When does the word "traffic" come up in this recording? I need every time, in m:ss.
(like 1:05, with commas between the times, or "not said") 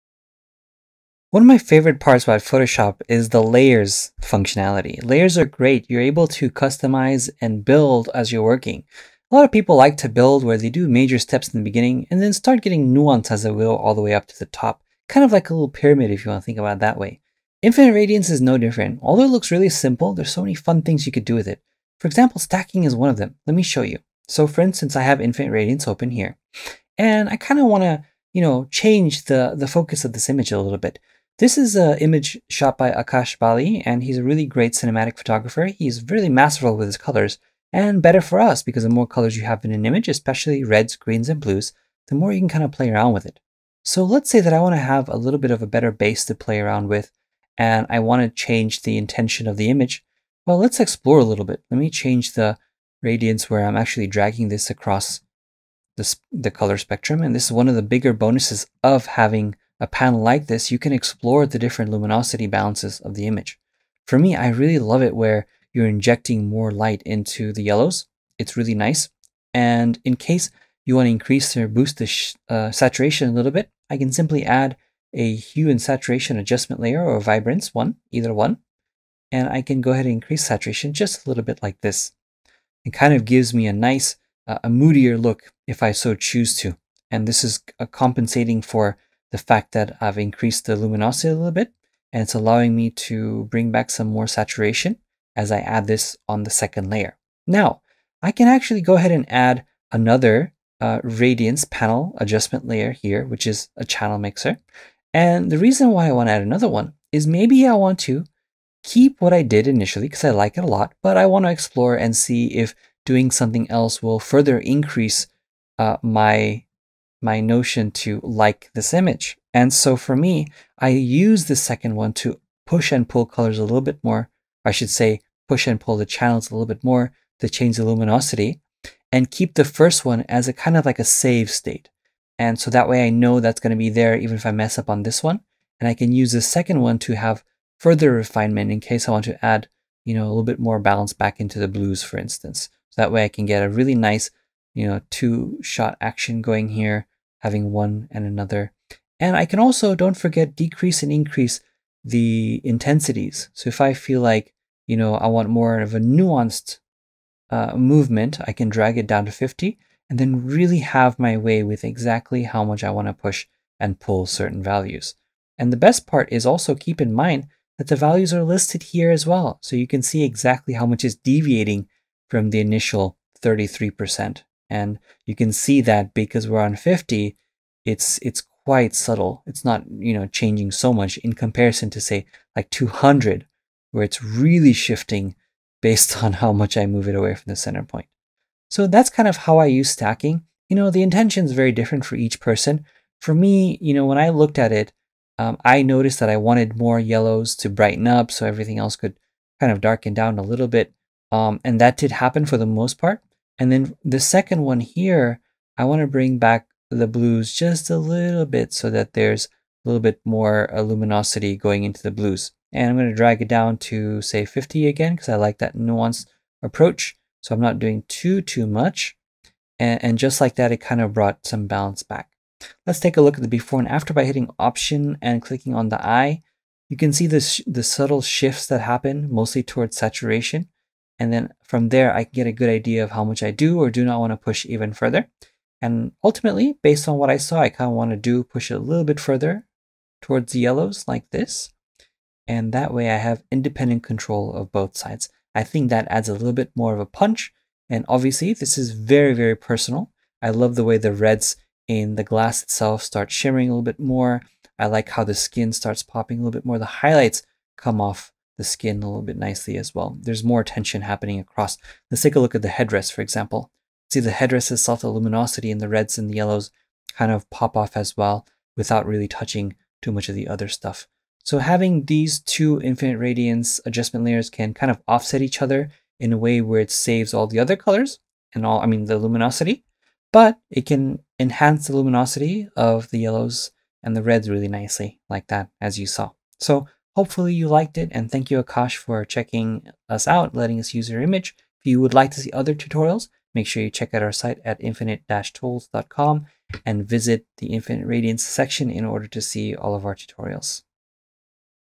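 not said.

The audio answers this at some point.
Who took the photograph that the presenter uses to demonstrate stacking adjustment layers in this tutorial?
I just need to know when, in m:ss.
0:32.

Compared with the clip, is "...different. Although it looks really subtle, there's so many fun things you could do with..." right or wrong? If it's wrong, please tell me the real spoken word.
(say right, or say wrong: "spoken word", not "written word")
wrong: "simple", not "subtle".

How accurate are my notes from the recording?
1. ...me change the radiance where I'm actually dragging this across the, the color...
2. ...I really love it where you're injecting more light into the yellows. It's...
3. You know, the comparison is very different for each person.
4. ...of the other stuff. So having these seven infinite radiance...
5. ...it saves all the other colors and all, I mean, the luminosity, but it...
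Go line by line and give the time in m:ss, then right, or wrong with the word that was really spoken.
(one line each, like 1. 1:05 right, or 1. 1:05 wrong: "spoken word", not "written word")
1. 0:51 right
2. 1:04 right
3. 3:10 wrong: "intention", not "comparison"
4. 4:30 wrong: "two", not "seven"
5. 4:36 right.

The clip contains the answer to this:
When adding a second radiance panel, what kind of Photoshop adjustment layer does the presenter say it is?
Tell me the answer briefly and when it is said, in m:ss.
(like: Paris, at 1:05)
Channel mixer, at 1:43.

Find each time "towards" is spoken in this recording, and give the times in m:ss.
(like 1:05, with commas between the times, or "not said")
3:49, 4:00.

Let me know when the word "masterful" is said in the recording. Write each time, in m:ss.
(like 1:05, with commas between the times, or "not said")
0:36.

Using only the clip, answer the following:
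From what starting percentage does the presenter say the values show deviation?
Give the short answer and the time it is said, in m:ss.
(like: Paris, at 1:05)
33%, at 2:53.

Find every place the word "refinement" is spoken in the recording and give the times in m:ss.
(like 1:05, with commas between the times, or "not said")
2:18.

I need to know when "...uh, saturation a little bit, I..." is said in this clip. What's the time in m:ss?
1:12.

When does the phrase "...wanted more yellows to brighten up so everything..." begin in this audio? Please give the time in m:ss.
3:16.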